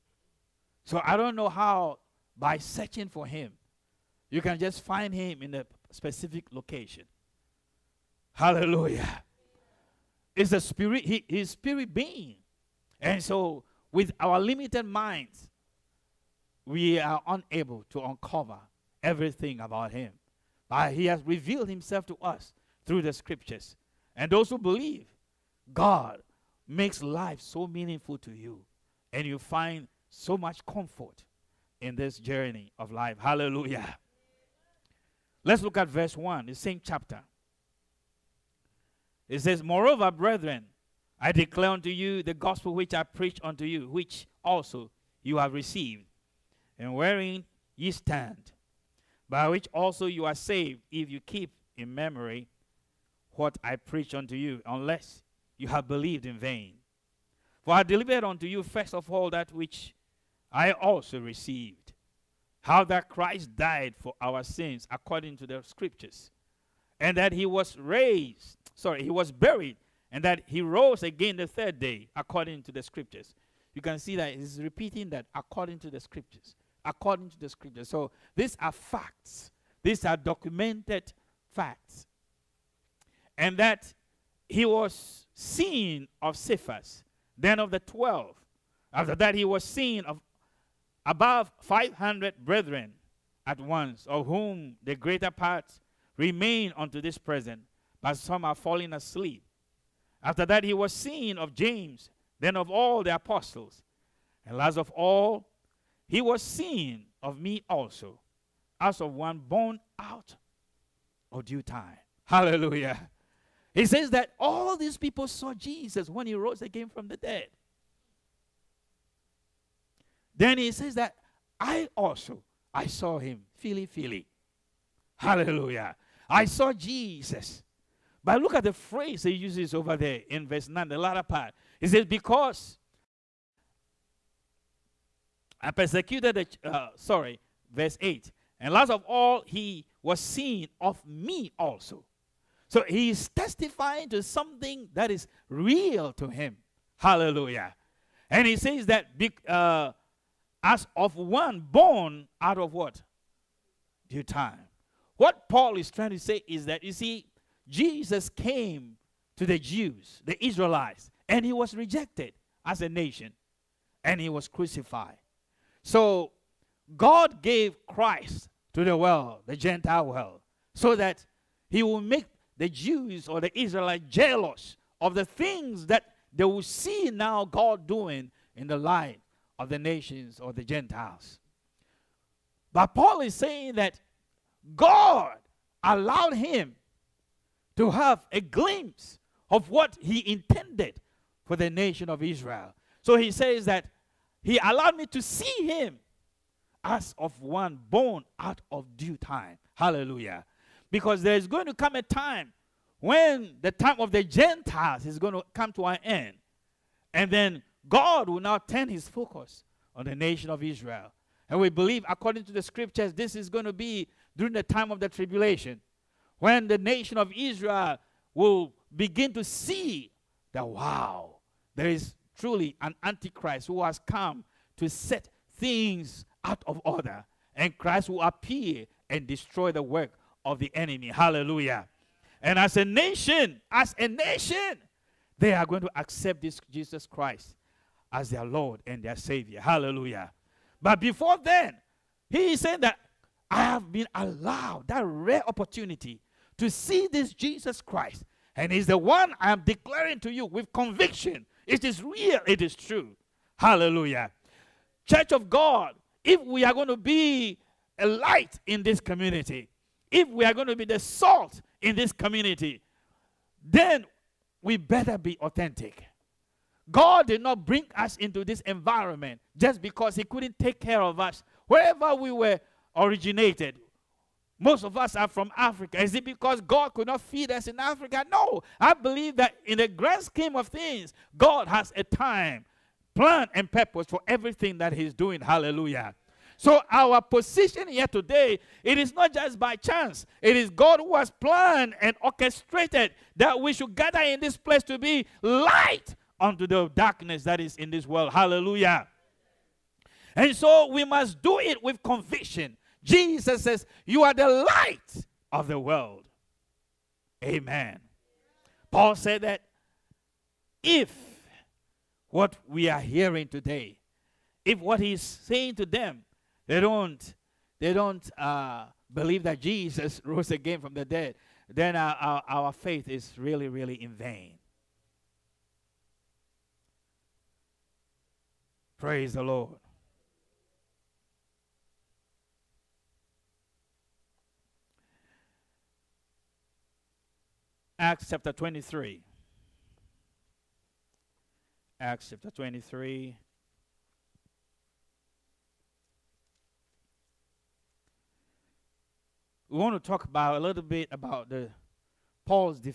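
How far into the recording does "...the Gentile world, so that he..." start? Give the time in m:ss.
2:49.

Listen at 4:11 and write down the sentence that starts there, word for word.
It is real, it is true.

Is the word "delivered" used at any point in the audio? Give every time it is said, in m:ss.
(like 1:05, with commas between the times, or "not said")
0:57.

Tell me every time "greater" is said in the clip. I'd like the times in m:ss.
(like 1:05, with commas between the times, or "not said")
1:34.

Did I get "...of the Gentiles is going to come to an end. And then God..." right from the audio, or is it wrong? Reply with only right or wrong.
right.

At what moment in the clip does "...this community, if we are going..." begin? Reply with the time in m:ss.
4:18.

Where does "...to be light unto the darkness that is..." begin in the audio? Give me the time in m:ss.
4:54.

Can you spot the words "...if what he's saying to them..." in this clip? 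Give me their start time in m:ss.
5:14.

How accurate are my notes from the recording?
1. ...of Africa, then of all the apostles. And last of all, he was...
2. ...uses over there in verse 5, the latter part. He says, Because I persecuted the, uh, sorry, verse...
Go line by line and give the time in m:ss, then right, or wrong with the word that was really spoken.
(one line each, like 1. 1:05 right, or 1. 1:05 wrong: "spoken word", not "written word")
1. 1:41 wrong: "James", not "Africa"
2. 2:09 wrong: "9", not "5".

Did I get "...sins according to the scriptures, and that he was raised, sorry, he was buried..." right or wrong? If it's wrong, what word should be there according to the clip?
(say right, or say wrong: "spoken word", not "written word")
right.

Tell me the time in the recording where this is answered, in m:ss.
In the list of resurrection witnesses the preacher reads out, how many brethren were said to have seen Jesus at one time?
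1:31.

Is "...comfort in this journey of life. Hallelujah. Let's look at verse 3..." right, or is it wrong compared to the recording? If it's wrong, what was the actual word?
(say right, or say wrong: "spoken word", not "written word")
wrong: "1", not "3".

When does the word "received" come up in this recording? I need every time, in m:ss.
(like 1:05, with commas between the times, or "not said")
0:45, 1:01.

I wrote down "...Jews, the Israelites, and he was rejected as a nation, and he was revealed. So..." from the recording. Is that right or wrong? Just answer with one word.
wrong.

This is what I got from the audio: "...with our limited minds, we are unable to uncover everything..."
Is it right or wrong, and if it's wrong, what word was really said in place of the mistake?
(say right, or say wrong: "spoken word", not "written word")
right.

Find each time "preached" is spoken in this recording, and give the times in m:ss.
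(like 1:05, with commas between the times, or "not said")
0:43, 0:53.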